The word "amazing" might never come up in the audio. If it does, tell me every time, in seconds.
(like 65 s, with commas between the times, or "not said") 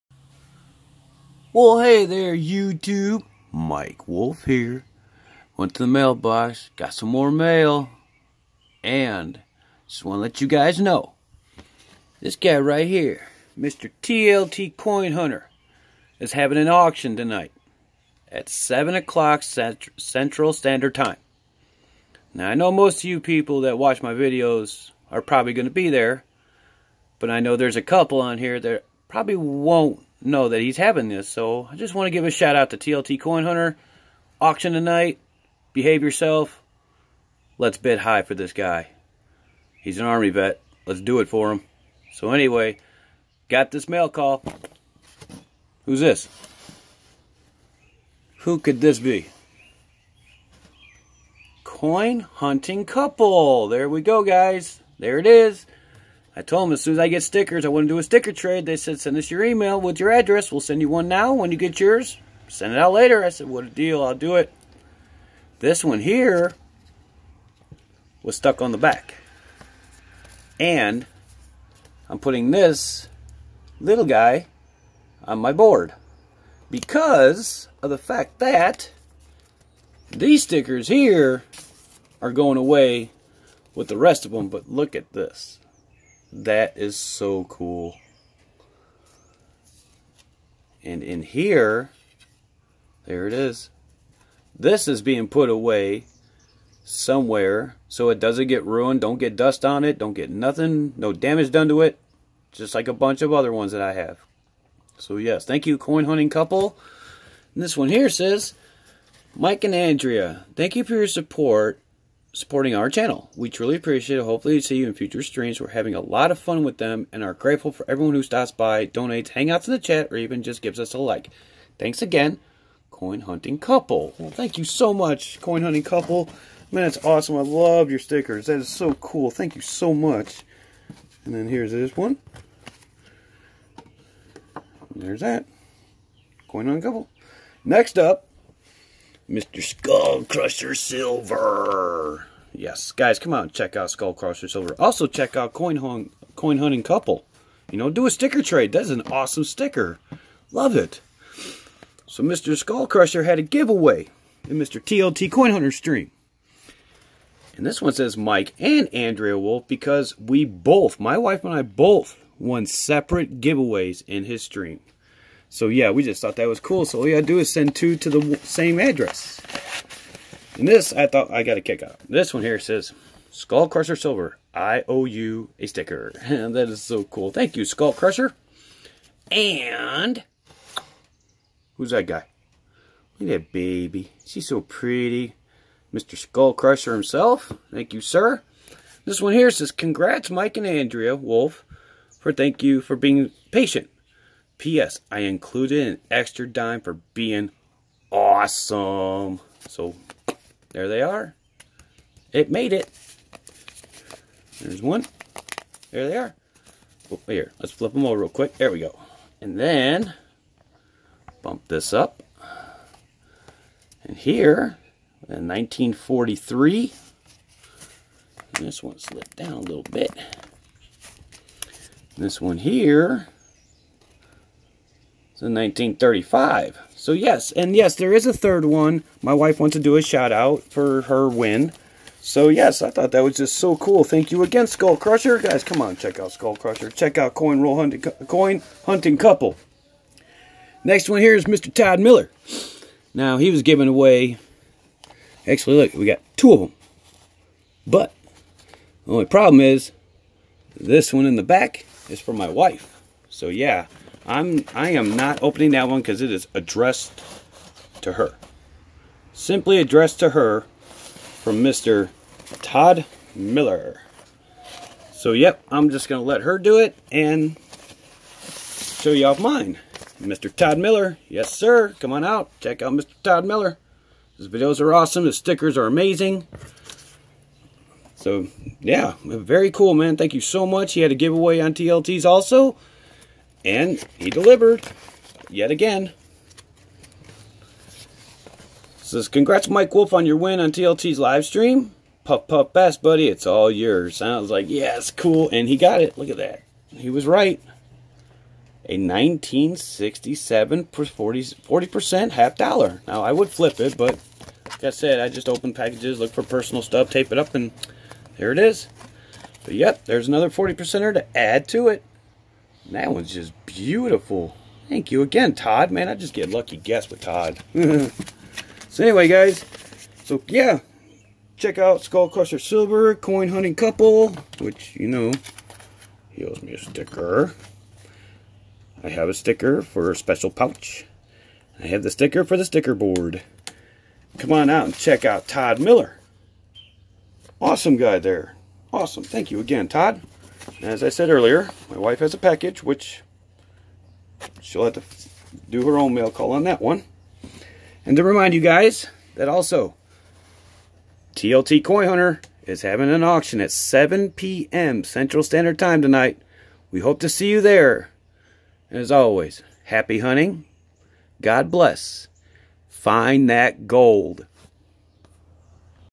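275 s.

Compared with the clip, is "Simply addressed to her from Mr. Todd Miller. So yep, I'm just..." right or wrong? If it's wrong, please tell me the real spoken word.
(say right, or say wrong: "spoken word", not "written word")
right.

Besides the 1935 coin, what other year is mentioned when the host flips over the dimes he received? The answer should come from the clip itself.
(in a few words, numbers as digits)
1943.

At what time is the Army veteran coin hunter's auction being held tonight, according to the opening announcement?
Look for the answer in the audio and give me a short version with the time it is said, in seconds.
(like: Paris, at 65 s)
7 o'clock, at 18 s.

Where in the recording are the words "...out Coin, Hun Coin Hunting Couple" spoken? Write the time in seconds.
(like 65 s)
145 s.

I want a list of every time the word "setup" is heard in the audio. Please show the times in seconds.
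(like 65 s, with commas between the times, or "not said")
not said.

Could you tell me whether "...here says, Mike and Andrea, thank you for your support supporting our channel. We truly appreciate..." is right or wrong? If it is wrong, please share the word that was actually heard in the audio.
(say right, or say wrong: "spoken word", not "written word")
right.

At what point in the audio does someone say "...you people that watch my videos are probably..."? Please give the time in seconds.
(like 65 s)
23 s.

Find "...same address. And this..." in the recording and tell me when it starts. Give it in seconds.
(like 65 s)
168 s.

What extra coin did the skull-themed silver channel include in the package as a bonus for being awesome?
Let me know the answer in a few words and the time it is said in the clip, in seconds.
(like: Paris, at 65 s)
an extra dime, at 195 s.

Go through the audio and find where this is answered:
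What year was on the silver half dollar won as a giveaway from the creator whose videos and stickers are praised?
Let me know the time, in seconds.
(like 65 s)
298 s.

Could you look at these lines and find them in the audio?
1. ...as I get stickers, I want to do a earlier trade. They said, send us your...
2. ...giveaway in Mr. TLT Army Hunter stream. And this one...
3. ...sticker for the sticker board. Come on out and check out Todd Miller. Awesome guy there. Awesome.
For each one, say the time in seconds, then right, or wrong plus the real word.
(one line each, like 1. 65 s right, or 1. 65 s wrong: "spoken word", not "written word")
1. 56 s wrong: "sticker", not "earlier"
2. 153 s wrong: "Coin", not "Army"
3. 332 s right.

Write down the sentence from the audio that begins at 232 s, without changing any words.
So yes, I thought that was just so cool.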